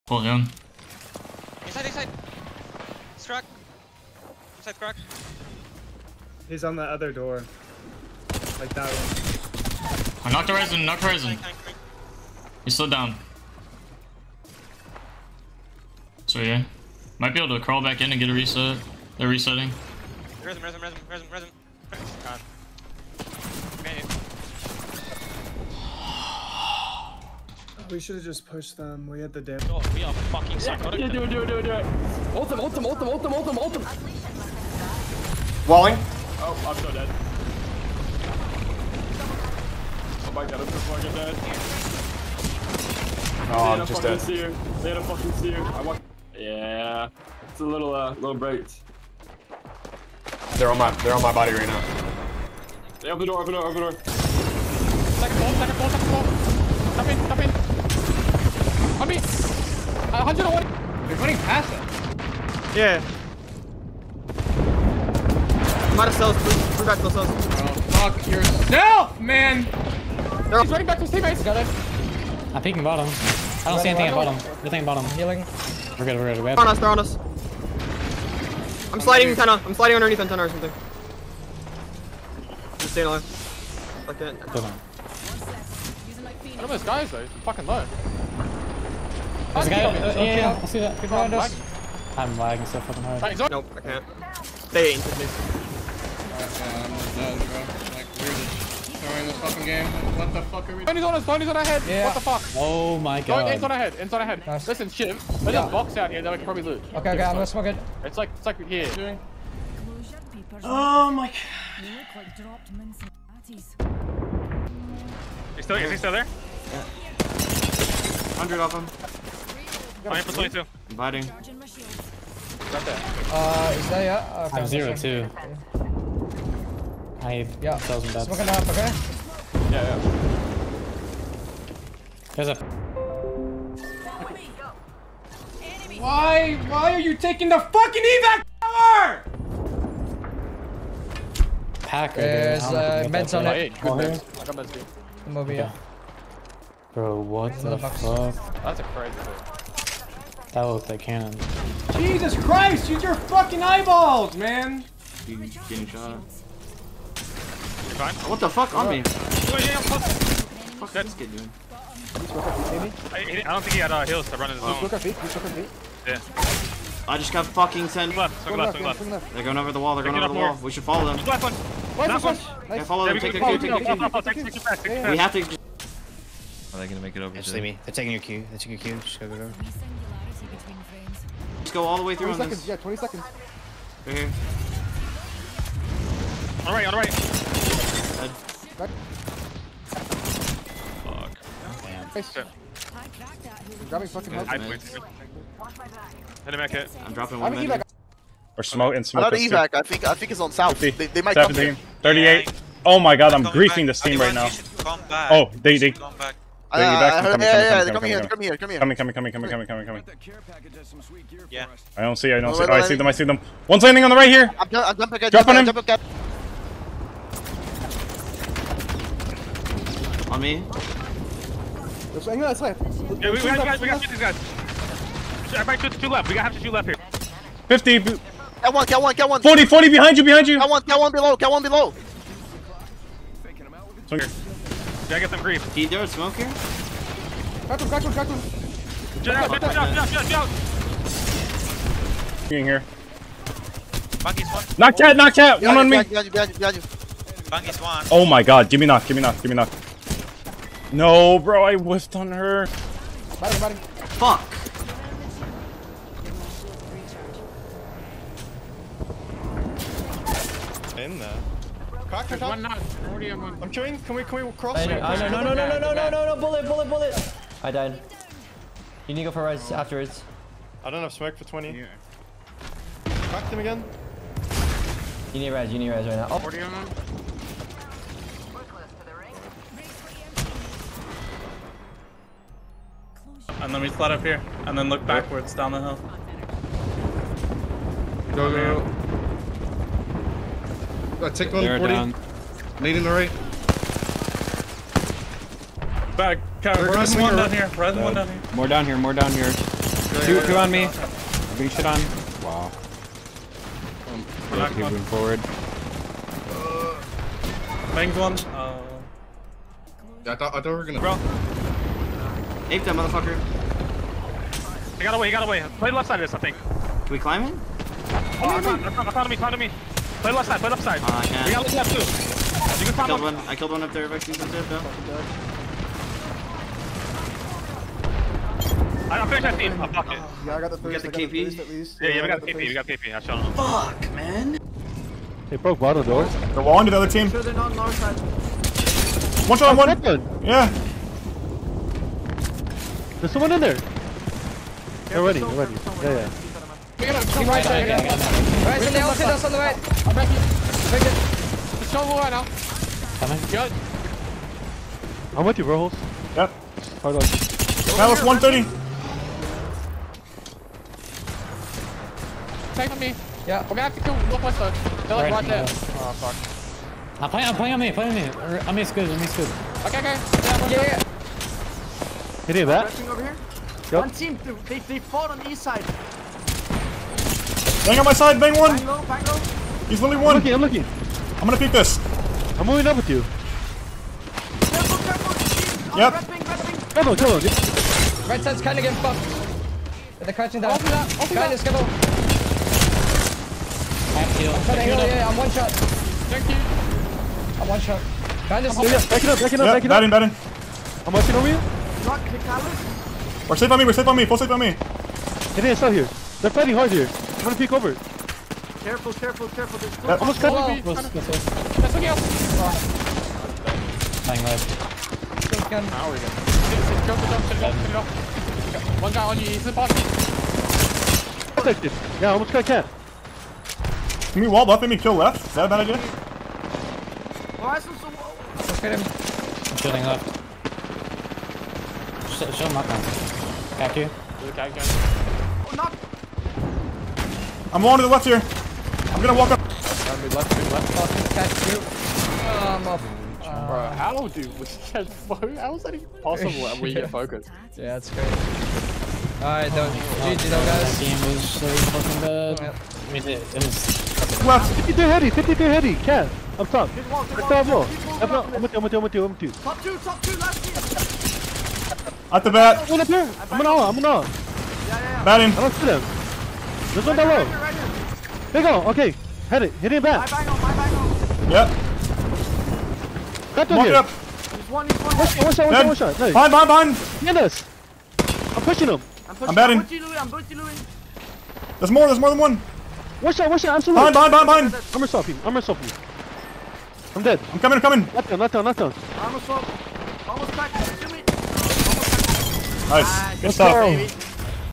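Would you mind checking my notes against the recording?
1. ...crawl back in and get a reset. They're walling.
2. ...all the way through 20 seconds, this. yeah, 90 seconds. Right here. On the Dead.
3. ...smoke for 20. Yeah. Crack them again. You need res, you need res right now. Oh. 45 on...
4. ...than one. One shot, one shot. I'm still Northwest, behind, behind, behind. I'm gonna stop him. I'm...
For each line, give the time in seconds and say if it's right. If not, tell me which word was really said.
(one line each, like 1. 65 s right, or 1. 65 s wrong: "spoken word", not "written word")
1. 17 s wrong: "resetting", not "walling"
2. 181 s wrong: "20", not "90"
3. 271 s wrong: "40", not "45"
4. 482 s wrong: "Behind", not "Northwest".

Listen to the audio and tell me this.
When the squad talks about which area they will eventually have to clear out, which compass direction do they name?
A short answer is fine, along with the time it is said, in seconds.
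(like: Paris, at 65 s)
Northwest, at 364 s.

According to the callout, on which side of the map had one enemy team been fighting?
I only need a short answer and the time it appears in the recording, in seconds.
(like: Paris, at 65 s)
East side, at 375 s.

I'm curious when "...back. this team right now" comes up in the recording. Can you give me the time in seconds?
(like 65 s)
203 s.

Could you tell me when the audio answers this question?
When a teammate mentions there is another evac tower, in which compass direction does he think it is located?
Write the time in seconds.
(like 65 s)
200 s.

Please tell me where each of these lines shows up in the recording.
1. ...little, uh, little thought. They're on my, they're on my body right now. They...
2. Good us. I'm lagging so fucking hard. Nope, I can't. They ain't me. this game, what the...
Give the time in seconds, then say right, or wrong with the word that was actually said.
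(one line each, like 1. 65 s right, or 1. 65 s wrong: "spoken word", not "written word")
1. 47 s wrong: "bright", not "thought"
2. 91 s right.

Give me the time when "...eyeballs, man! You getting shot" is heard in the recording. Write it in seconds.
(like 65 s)
153 s.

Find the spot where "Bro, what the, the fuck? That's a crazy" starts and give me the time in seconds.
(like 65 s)
146 s.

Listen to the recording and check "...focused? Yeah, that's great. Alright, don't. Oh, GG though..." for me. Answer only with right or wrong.
right.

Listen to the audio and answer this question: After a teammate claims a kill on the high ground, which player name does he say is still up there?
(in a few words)
Vexy.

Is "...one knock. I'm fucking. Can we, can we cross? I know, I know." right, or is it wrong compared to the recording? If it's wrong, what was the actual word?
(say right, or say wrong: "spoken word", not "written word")
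wrong: "chewing", not "fucking".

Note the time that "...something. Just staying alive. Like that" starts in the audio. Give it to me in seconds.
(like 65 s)
80 s.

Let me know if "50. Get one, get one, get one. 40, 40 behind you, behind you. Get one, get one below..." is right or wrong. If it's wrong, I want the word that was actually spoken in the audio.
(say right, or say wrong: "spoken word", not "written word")
right.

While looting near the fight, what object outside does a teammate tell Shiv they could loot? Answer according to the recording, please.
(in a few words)
A box.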